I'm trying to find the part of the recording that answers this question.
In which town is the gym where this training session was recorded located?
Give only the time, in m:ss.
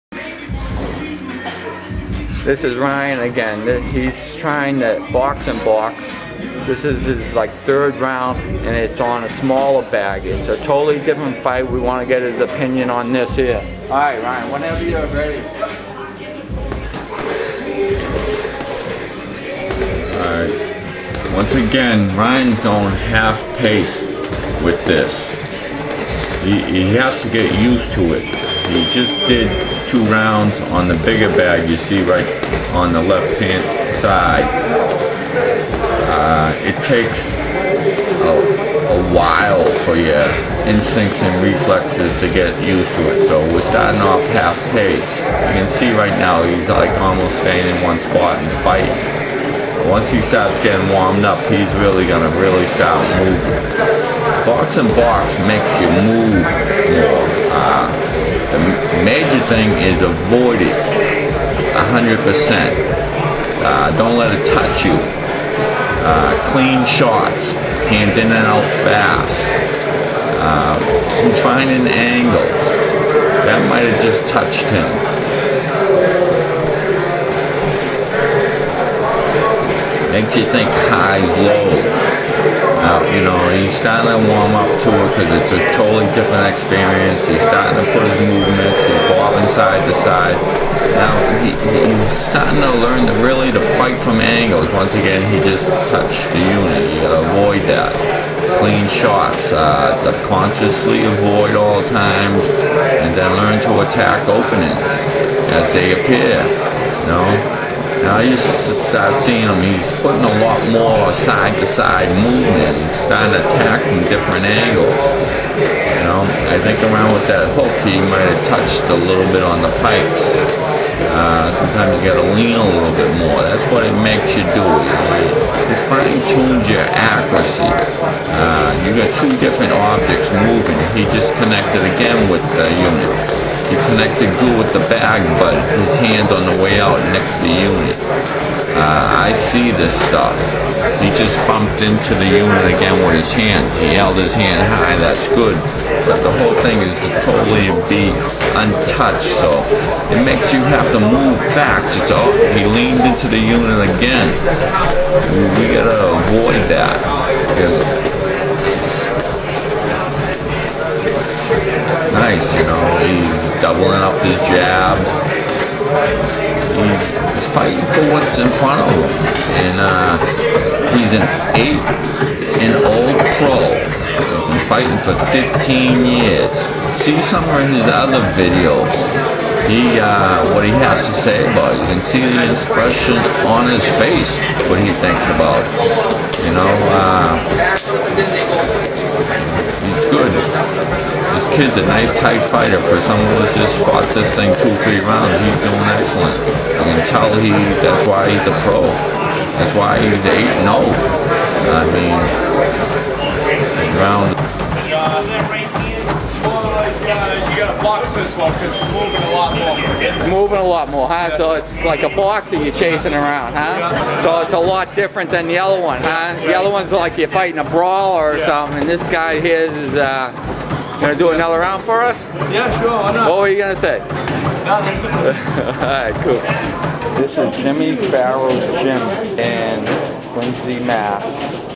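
3:50.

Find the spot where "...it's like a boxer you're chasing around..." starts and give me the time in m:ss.
3:31.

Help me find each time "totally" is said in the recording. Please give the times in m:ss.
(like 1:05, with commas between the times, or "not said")
0:10, 1:25, 2:27.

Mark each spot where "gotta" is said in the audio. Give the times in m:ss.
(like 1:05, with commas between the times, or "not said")
1:37, 2:02, 2:35.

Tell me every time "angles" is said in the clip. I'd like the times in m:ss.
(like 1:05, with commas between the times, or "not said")
1:11, 1:34, 1:54.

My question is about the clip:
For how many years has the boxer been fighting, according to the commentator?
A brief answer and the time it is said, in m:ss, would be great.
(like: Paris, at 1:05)
15, at 2:55.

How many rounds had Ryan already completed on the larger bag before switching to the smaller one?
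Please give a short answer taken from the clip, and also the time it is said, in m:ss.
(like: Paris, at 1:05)
2, at 0:29.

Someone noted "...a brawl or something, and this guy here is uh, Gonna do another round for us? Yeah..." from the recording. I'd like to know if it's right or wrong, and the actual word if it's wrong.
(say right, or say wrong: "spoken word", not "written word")
right.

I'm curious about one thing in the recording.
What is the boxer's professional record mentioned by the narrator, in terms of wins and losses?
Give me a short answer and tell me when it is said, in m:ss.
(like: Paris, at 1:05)
8-0, at 3:20.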